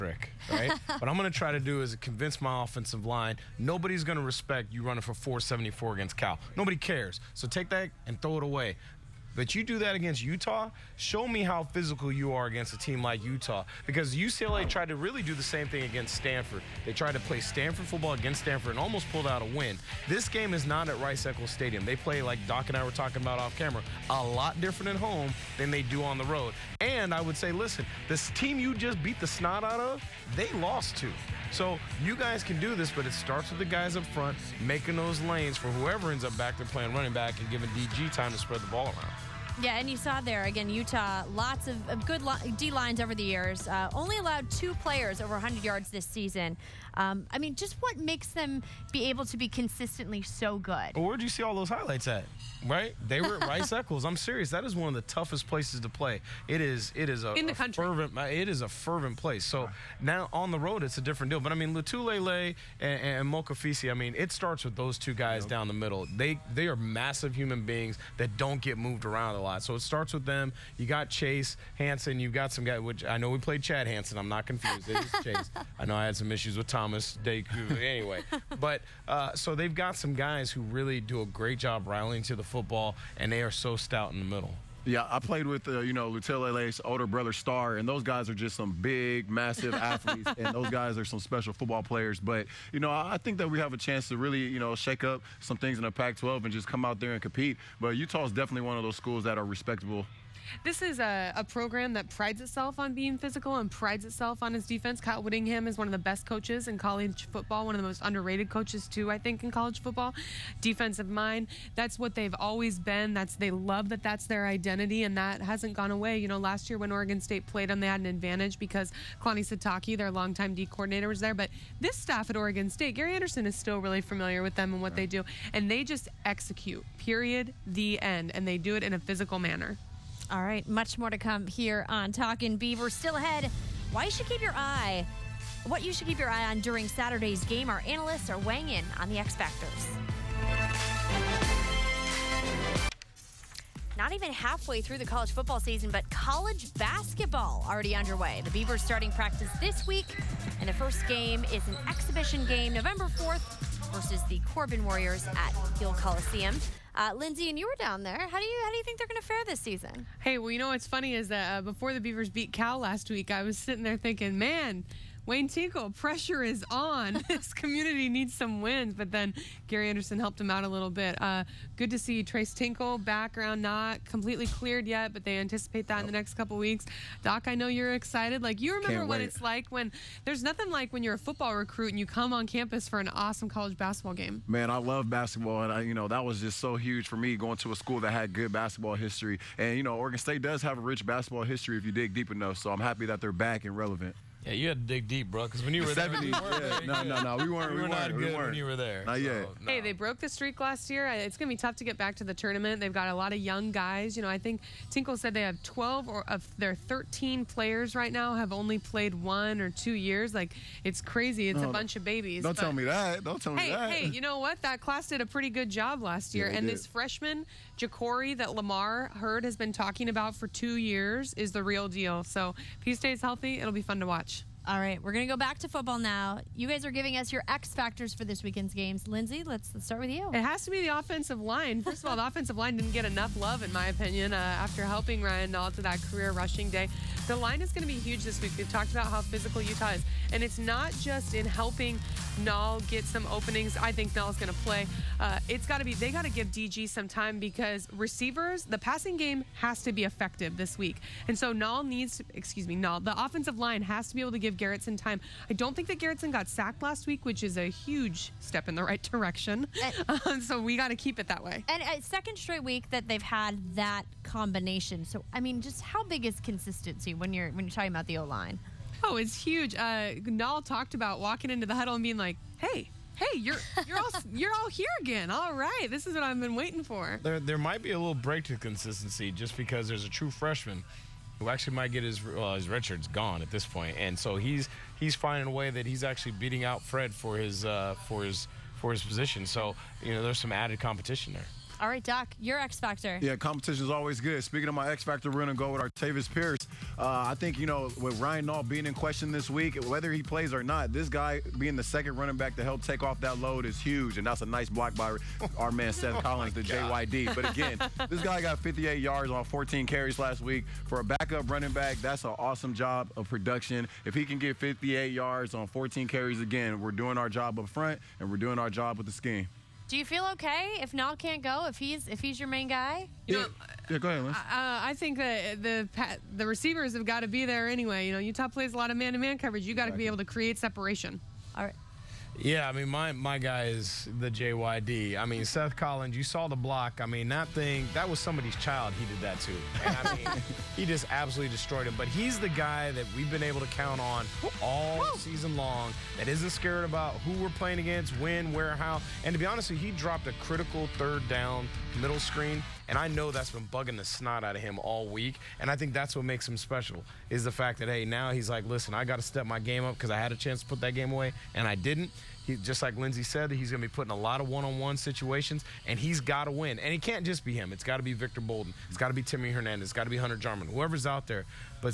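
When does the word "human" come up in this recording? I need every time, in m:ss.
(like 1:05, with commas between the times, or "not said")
1:07.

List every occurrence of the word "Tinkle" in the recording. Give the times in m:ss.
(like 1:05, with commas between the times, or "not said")
2:45, 2:52, 3:24.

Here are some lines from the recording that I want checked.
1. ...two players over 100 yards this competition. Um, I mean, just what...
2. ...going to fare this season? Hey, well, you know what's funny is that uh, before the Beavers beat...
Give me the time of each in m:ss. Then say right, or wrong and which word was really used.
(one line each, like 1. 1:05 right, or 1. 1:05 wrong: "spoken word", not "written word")
1. 0:44 wrong: "season", not "competition"
2. 2:39 right.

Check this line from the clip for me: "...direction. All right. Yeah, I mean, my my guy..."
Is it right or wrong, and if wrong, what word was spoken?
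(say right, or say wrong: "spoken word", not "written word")
wrong: "separation", not "direction".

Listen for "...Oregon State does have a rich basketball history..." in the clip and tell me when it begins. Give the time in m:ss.
3:09.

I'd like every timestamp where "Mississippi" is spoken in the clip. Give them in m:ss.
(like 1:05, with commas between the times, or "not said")
not said.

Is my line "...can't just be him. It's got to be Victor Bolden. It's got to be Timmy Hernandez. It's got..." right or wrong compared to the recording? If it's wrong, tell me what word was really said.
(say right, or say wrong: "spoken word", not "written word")
right.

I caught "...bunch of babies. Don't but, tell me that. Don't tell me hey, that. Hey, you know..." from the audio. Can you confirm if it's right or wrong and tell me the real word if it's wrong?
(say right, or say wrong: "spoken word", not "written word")
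right.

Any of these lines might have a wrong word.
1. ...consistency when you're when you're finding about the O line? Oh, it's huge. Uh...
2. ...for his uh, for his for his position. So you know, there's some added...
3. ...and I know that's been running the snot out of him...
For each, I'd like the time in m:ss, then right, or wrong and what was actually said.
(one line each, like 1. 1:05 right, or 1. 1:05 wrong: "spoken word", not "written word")
1. 4:26 wrong: "talking", not "finding"
2. 4:47 right
3. 5:52 wrong: "bugging", not "running".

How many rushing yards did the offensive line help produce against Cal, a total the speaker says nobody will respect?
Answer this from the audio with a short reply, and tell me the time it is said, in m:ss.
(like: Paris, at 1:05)
474, at 0:05.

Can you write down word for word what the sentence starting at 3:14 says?
Yeah, you had to dig deep, bro, because when you the were 70s, there, we yeah.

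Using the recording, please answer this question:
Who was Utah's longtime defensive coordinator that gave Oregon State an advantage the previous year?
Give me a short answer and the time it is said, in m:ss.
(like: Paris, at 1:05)
Kalani Sitake, at 1:59.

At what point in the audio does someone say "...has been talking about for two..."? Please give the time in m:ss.
3:39.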